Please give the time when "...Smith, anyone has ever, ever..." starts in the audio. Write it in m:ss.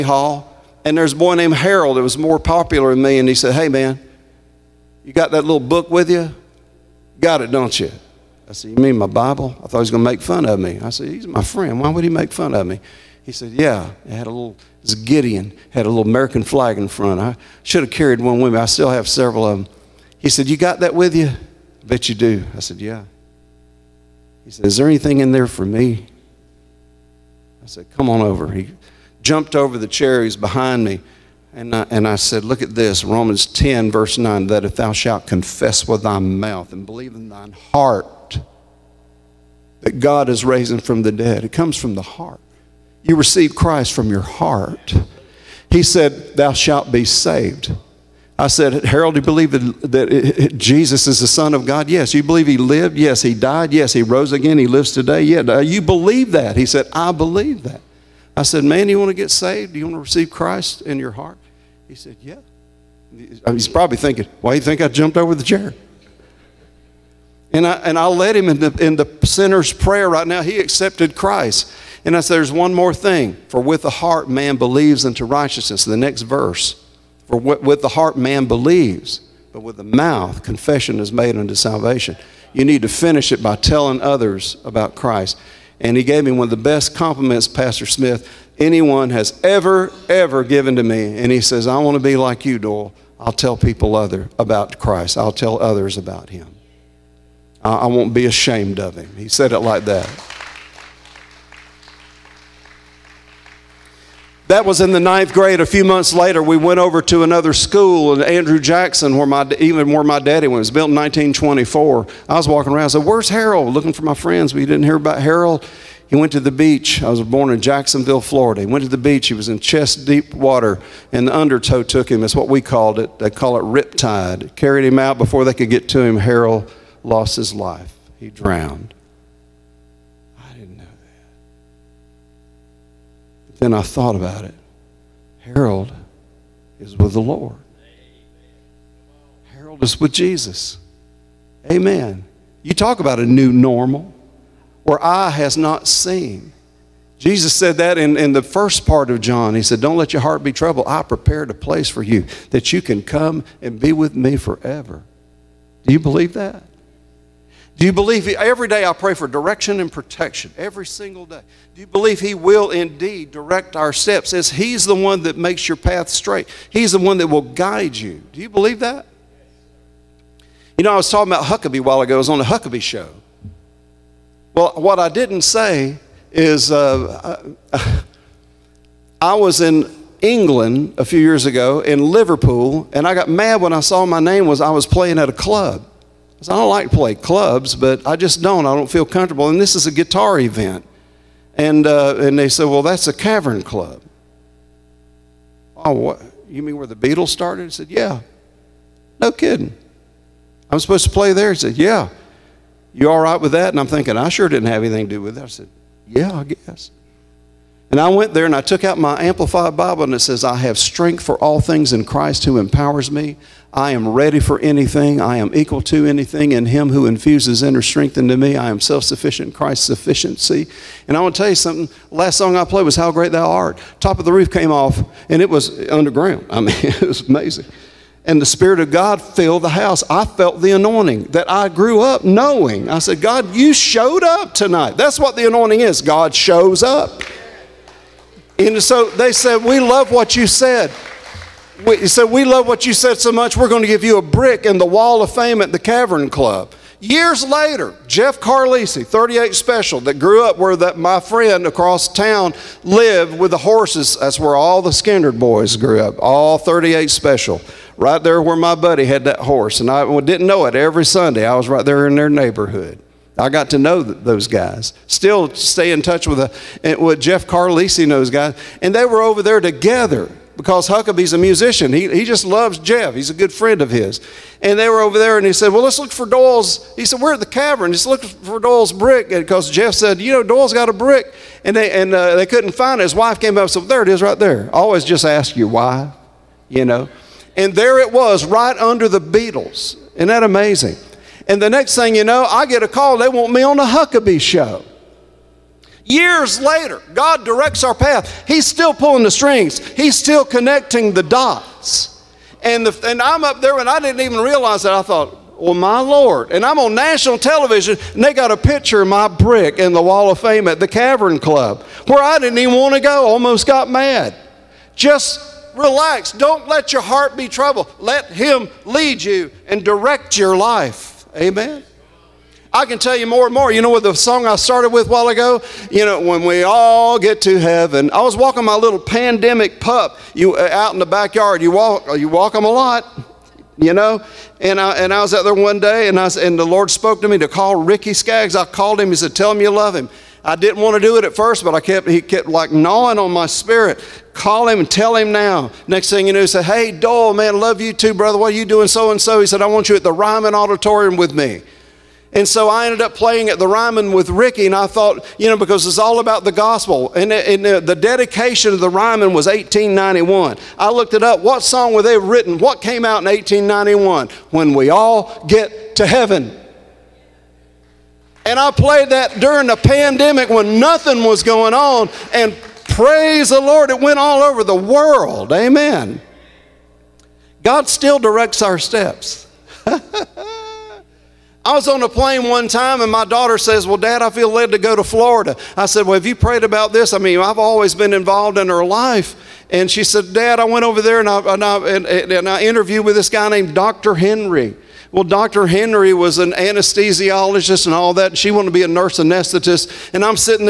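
1:27.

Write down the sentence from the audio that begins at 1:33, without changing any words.
I'll tell people other about Christ.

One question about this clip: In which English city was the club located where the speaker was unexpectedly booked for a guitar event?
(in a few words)
Liverpool.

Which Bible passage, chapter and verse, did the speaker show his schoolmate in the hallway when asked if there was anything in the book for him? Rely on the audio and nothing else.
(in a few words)
Romans 10:9.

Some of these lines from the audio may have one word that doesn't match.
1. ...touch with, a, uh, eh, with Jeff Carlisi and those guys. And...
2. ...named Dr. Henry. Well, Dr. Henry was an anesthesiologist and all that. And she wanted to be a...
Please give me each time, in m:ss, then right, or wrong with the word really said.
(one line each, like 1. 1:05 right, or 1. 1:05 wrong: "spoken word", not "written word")
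1. 4:26 right
2. 6:33 right.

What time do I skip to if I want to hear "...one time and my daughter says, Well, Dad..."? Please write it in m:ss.
6:22.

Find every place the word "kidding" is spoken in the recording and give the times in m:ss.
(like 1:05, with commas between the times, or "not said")
3:19.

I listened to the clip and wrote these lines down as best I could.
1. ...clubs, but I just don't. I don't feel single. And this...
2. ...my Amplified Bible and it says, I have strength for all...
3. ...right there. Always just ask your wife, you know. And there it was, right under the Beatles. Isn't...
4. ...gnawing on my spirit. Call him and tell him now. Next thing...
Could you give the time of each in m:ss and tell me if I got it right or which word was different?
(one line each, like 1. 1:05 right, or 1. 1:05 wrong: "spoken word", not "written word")
1. 3:07 wrong: "comfortable", not "single"
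2. 3:28 right
3. 4:44 right
4. 5:42 right.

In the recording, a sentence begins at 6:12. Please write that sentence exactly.
And praise the Lord, it went all over the world.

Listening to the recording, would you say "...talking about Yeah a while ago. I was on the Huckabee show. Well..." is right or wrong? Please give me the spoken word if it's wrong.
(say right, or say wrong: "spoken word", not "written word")
wrong: "Huckabee", not "Yeah".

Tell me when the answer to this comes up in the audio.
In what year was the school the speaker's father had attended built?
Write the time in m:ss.
1:50.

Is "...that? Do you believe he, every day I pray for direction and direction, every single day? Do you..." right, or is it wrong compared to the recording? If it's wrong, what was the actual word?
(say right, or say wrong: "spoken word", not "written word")
wrong: "protection", not "direction".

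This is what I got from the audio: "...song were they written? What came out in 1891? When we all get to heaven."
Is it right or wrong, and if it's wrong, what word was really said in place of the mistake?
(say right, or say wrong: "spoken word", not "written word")
right.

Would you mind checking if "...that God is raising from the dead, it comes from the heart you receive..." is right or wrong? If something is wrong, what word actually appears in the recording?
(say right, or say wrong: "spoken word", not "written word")
right.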